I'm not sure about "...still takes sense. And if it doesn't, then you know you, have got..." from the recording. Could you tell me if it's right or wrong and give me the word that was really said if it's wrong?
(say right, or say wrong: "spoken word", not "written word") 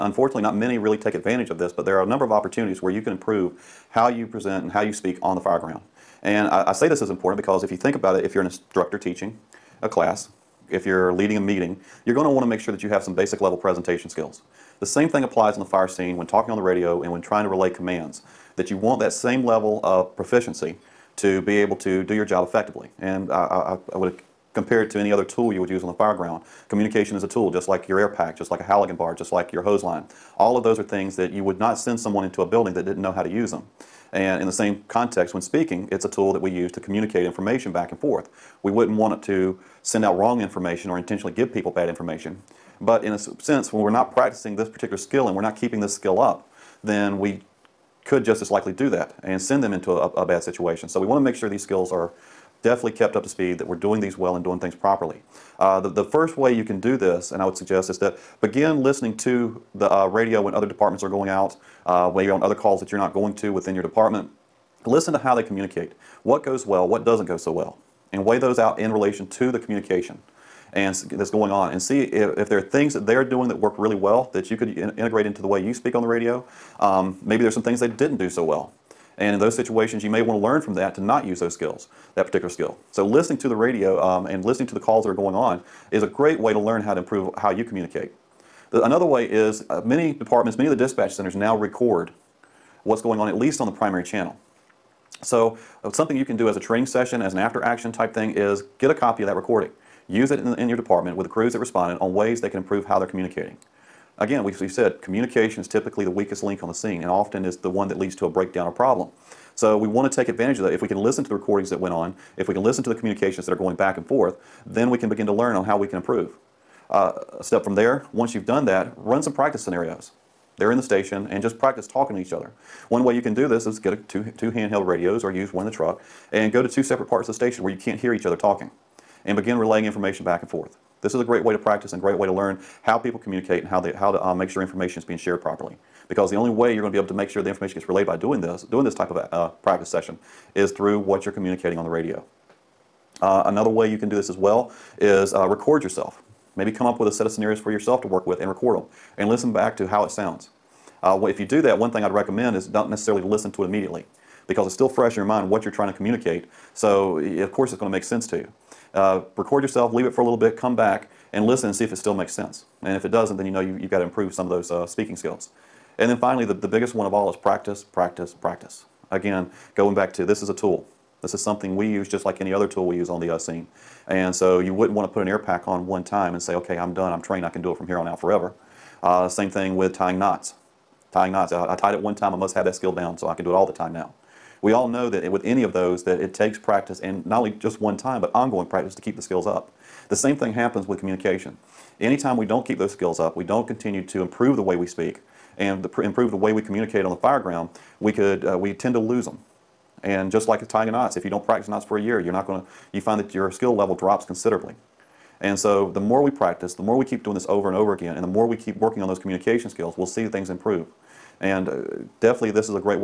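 wrong: "makes", not "takes".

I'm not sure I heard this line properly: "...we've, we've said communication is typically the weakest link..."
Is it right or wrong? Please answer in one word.
right.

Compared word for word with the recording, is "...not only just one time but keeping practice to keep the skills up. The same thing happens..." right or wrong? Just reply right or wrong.
wrong.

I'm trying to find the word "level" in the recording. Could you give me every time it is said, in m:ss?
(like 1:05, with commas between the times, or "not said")
0:13, 0:19, 3:23.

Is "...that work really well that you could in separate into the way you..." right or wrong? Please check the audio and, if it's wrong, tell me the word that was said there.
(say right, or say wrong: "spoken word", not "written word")
wrong: "integrate", not "separate".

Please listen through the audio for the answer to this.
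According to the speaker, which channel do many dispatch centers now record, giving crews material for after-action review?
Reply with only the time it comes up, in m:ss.
1:33.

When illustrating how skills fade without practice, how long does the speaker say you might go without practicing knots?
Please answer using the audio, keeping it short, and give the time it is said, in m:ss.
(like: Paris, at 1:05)
a year, at 3:21.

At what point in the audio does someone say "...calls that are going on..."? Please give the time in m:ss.
1:24.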